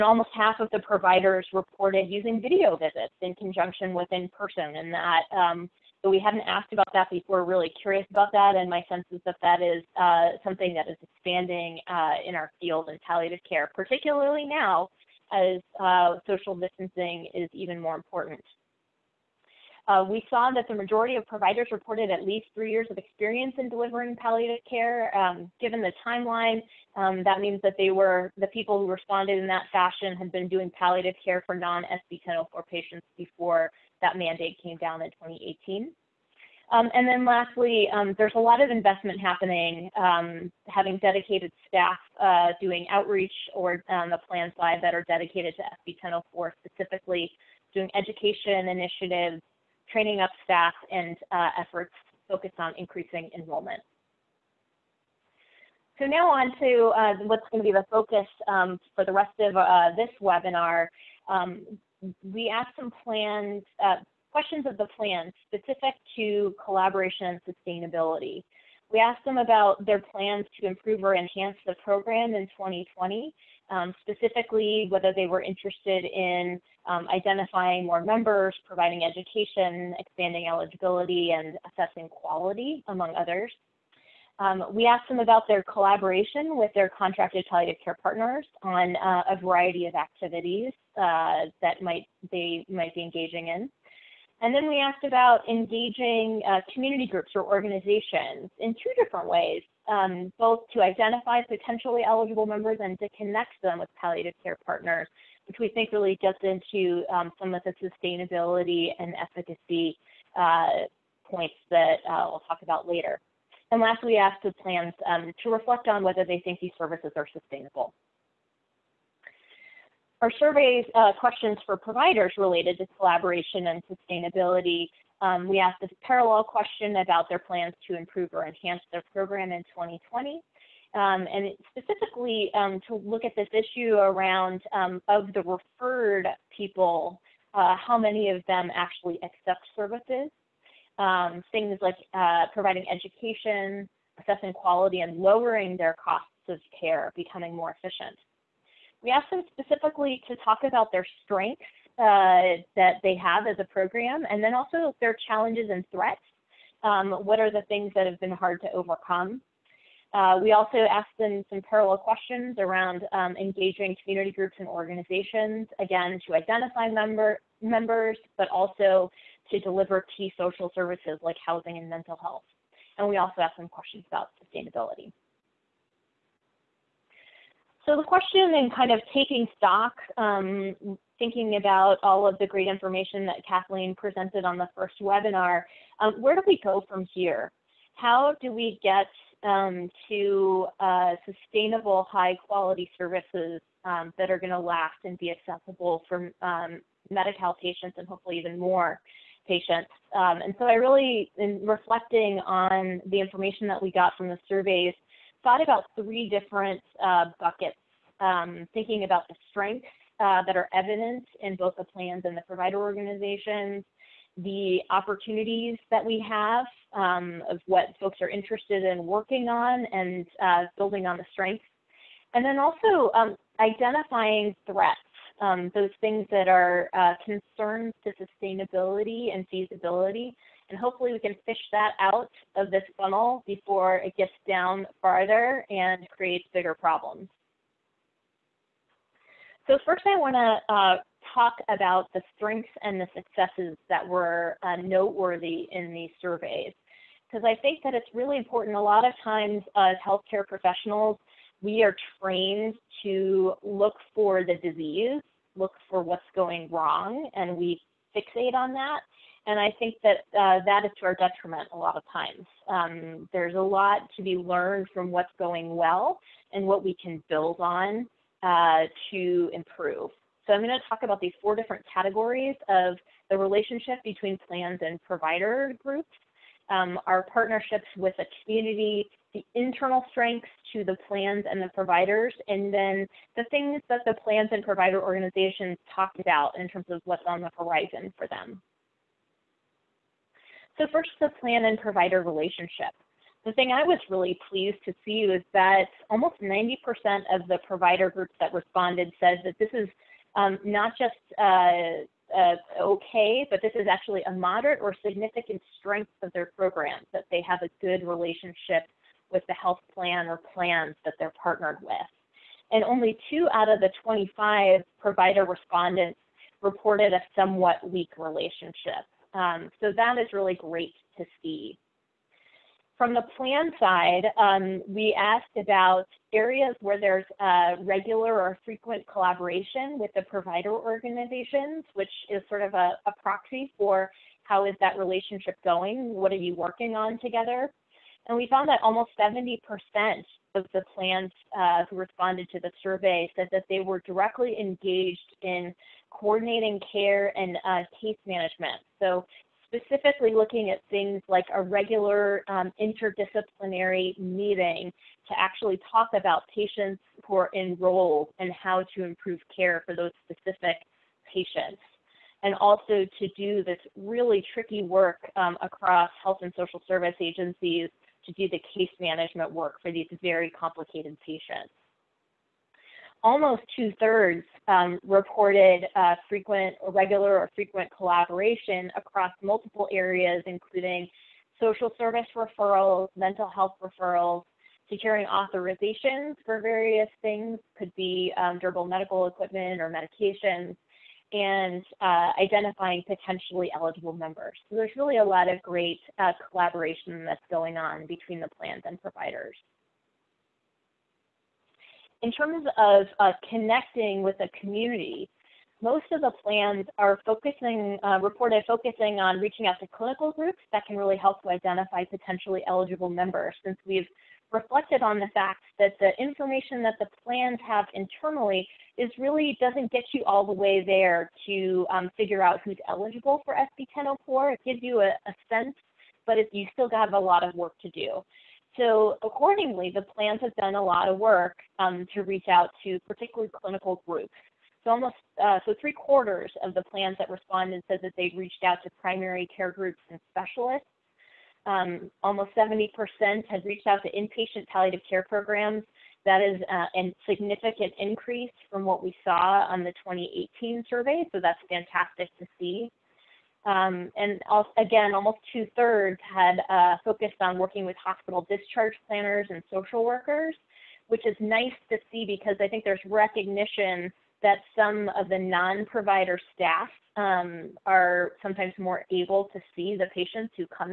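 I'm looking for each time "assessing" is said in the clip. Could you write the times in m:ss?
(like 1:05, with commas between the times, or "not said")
1:21, 2:24.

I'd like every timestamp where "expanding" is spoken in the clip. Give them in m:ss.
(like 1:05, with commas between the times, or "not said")
0:11, 1:19.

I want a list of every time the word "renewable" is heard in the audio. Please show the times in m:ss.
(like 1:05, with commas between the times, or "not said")
not said.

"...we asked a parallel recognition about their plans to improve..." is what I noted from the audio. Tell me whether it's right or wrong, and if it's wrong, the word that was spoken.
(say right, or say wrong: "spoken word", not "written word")
wrong: "question", not "recognition".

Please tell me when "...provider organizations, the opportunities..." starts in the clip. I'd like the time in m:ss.
3:32.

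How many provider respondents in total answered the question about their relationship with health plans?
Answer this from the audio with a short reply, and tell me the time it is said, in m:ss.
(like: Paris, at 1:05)
25, at 5:14.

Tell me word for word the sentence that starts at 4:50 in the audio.
So first, the plan and provider relationship.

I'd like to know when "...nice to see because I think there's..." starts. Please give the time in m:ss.
7:41.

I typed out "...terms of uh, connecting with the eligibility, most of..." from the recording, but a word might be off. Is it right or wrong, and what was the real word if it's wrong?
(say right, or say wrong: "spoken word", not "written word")
wrong: "community", not "eligibility".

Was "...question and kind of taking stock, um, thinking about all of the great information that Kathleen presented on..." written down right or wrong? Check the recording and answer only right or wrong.
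right.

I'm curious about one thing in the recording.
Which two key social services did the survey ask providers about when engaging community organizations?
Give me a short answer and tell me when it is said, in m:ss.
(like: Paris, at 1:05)
housing and mental health, at 2:51.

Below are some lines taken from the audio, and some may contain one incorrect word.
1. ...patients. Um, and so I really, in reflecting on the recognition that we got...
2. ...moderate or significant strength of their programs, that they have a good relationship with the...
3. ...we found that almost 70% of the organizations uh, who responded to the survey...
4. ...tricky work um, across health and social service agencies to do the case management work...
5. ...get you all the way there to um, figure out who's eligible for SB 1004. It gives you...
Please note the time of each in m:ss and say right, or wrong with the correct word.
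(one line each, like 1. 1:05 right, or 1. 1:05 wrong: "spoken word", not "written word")
1. 3:19 wrong: "information", not "recognition"
2. 5:04 right
3. 5:38 wrong: "plans", not "organizations"
4. 6:04 right
5. 6:59 right.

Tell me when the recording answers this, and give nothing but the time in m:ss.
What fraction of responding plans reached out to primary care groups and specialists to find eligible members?
7:15.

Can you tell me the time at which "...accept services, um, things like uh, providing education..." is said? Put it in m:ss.
2:19.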